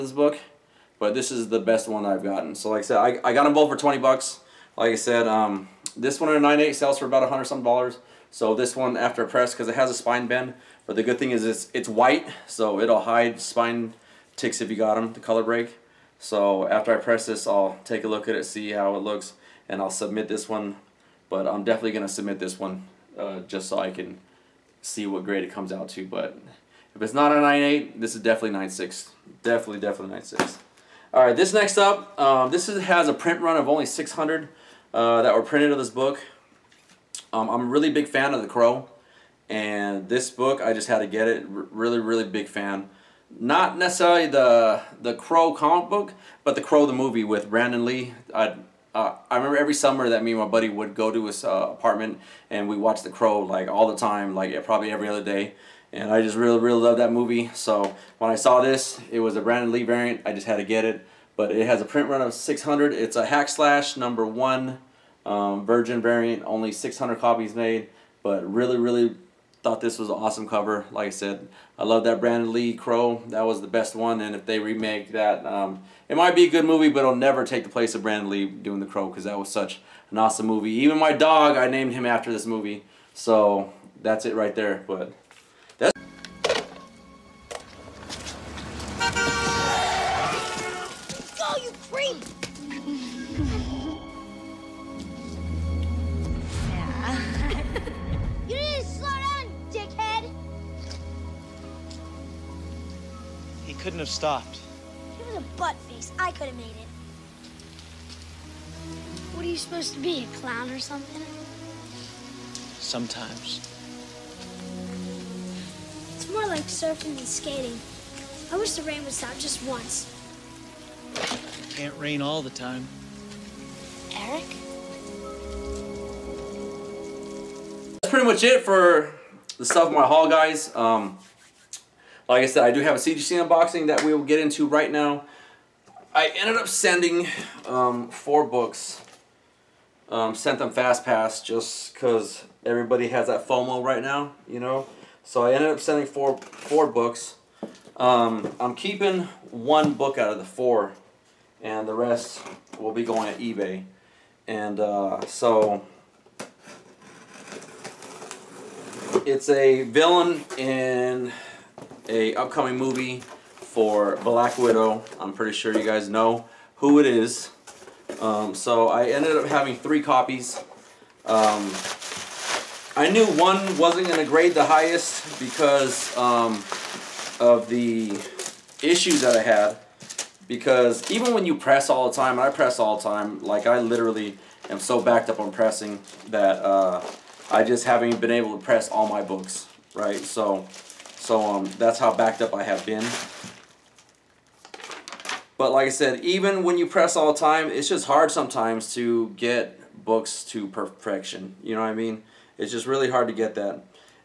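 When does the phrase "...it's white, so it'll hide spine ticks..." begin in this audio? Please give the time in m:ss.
0:11.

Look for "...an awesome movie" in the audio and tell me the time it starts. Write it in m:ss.
1:20.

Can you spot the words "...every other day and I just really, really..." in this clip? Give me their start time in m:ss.
0:54.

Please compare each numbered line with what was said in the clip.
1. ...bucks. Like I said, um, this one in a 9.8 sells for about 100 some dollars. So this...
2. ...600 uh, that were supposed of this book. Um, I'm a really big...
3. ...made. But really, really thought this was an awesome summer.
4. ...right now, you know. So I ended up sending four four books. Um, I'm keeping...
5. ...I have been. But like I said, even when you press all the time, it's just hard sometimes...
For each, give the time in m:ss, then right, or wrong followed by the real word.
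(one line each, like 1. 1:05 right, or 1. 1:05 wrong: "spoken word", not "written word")
1. 0:03 right
2. 0:33 wrong: "printed", not "supposed"
3. 1:07 wrong: "cover", not "summer"
4. 2:23 right
5. 3:12 right.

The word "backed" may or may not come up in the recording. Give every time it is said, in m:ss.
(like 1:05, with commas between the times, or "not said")
3:05, 3:12.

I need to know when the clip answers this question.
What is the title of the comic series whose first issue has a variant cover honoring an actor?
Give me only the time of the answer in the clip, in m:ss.
1:03.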